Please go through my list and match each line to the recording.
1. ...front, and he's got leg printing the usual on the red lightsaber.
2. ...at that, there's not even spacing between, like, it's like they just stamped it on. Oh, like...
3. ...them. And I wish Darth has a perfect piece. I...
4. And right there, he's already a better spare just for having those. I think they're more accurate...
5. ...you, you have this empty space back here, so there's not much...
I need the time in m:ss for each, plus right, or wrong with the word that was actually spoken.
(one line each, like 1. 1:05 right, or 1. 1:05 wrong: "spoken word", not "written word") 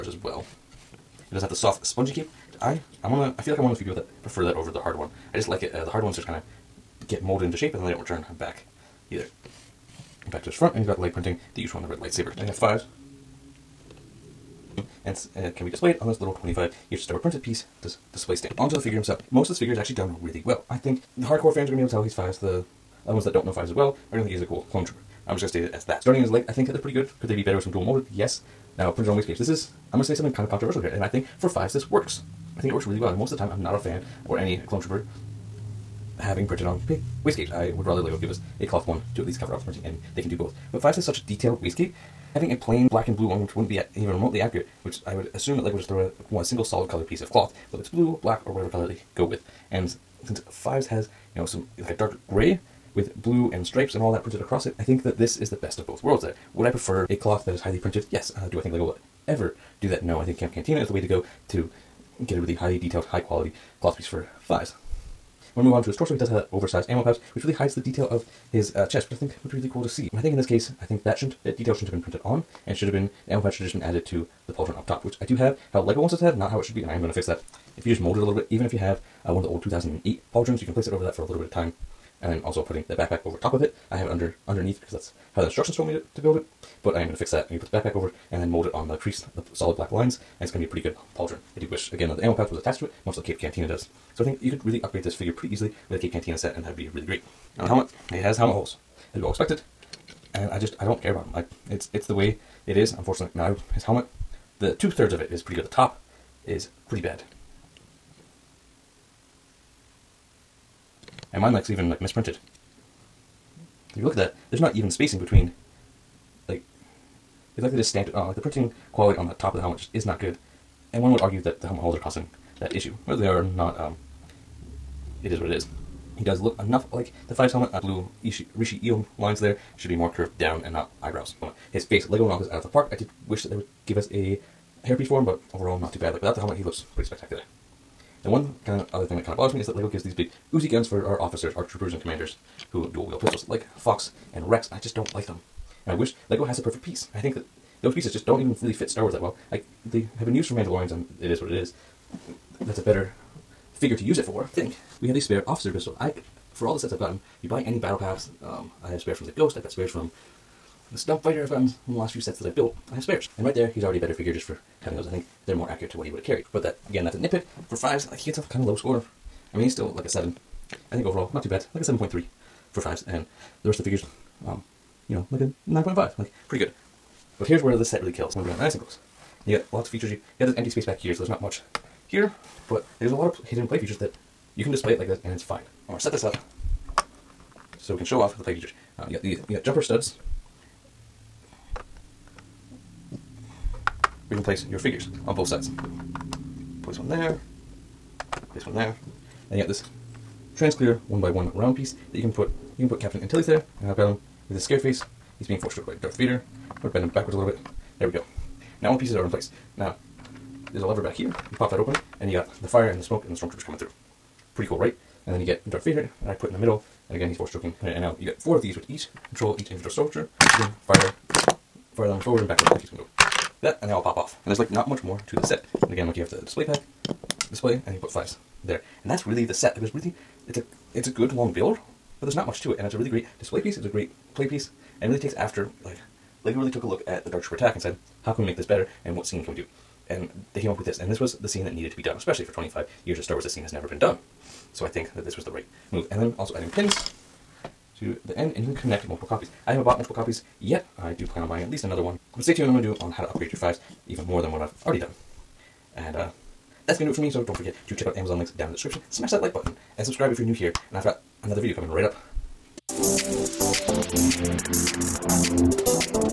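1. 0:10 right
2. 1:54 right
3. 2:25 wrong: "Lego", not "Darth"
4. 2:43 wrong: "figure", not "spare"
5. 3:00 right.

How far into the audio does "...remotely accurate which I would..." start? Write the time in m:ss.
0:44.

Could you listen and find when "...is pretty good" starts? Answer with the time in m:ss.
1:45.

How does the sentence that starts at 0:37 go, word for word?
I would rather Lego give us a cloth one to at least cover up the printing, and they can do both.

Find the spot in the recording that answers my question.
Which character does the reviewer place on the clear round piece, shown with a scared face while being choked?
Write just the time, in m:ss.
3:22.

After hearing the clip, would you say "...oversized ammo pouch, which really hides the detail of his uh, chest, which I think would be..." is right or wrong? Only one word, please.
right.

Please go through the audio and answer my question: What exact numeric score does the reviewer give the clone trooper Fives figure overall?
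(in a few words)
7.3.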